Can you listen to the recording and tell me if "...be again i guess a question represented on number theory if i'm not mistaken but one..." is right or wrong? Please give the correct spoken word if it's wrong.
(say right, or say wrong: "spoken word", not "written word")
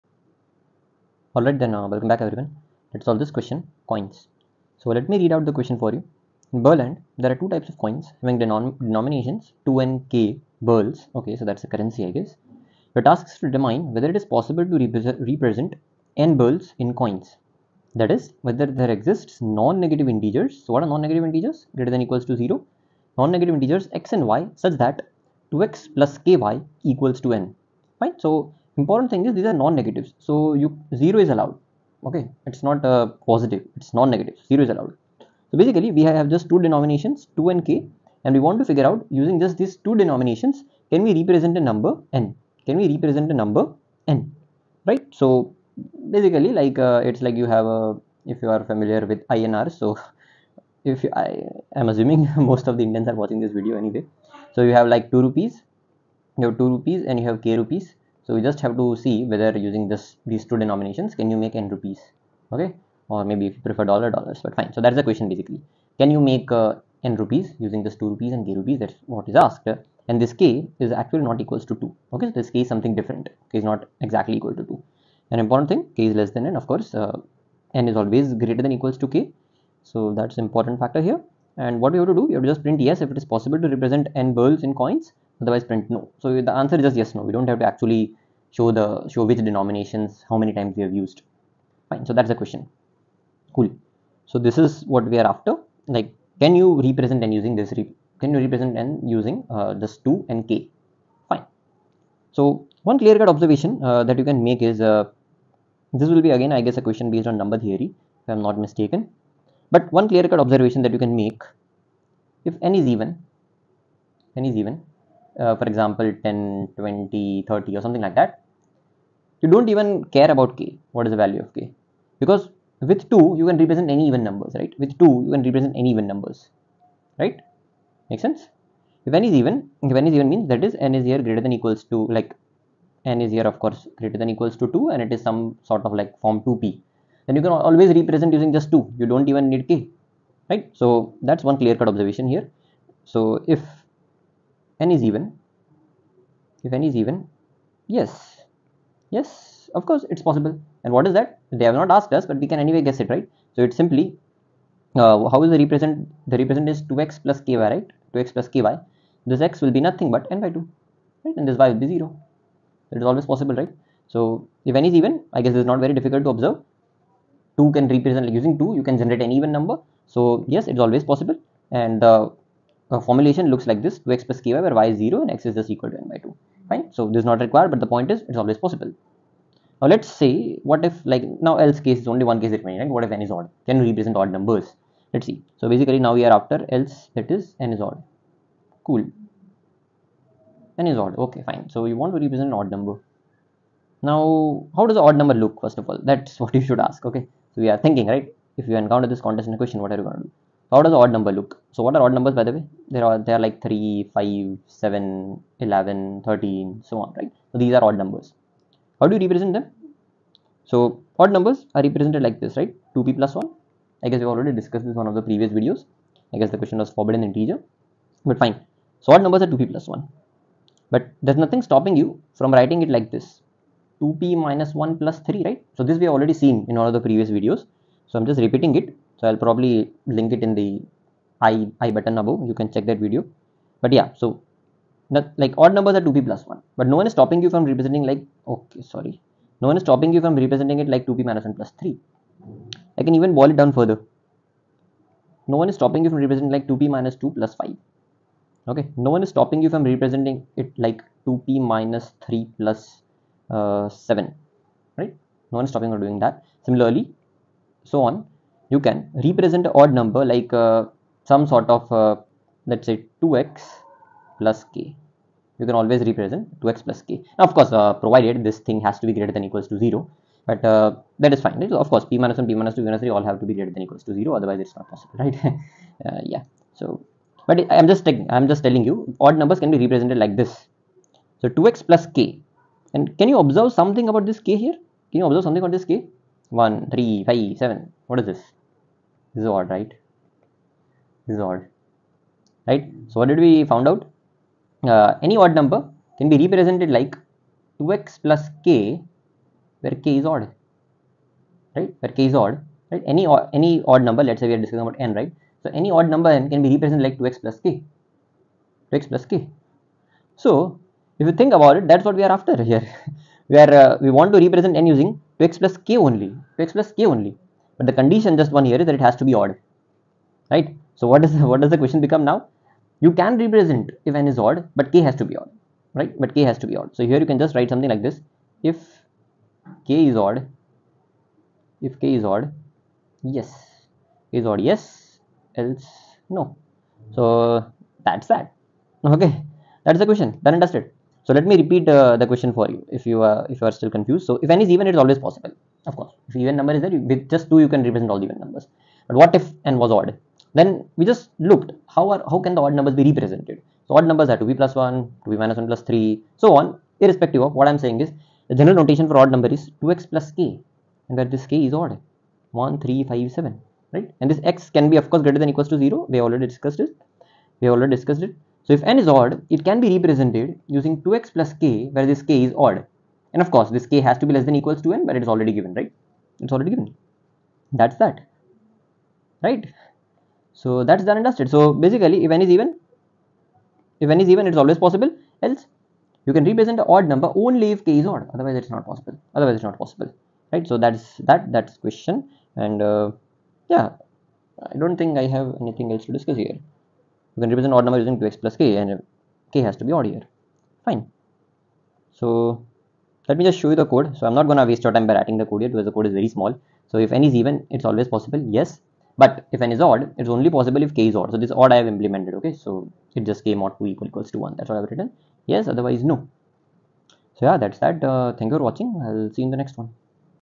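wrong: "based", not "represented".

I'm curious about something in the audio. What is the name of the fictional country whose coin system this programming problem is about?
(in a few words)
Berland.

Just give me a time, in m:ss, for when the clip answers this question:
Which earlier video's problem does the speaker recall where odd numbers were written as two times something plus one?
3:36.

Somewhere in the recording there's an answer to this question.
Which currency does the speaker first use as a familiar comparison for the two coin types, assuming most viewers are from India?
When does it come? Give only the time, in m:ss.
0:49.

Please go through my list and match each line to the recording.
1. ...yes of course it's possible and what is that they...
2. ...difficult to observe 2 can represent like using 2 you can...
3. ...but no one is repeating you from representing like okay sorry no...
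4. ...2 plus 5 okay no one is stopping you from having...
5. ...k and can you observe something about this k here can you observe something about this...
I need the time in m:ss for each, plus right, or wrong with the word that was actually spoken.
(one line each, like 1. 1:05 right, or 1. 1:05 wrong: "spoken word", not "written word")
1. 2:29 right
2. 2:45 right
3. 3:56 wrong: "stopping", not "repeating"
4. 4:07 wrong: "representing", not "having"
5. 4:42 right.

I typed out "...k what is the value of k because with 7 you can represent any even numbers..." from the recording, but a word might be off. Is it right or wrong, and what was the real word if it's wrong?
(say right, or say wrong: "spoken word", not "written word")
wrong: "2", not "7".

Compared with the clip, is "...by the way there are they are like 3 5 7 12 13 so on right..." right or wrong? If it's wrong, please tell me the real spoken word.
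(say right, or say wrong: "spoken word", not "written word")
wrong: "11", not "12".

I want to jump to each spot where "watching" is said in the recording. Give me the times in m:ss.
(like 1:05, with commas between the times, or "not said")
0:53, 6:58.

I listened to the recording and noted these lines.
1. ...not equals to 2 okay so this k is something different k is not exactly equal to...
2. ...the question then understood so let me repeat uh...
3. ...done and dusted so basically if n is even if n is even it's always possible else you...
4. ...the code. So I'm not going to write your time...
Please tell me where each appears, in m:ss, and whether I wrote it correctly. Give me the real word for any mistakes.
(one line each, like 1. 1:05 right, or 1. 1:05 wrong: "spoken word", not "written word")
1. 1:11 right
2. 5:40 right
3. 6:21 right
4. 6:43 wrong: "waste", not "write".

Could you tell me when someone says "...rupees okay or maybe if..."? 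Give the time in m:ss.
1:01.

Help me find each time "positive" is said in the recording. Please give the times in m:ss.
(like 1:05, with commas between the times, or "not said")
0:33.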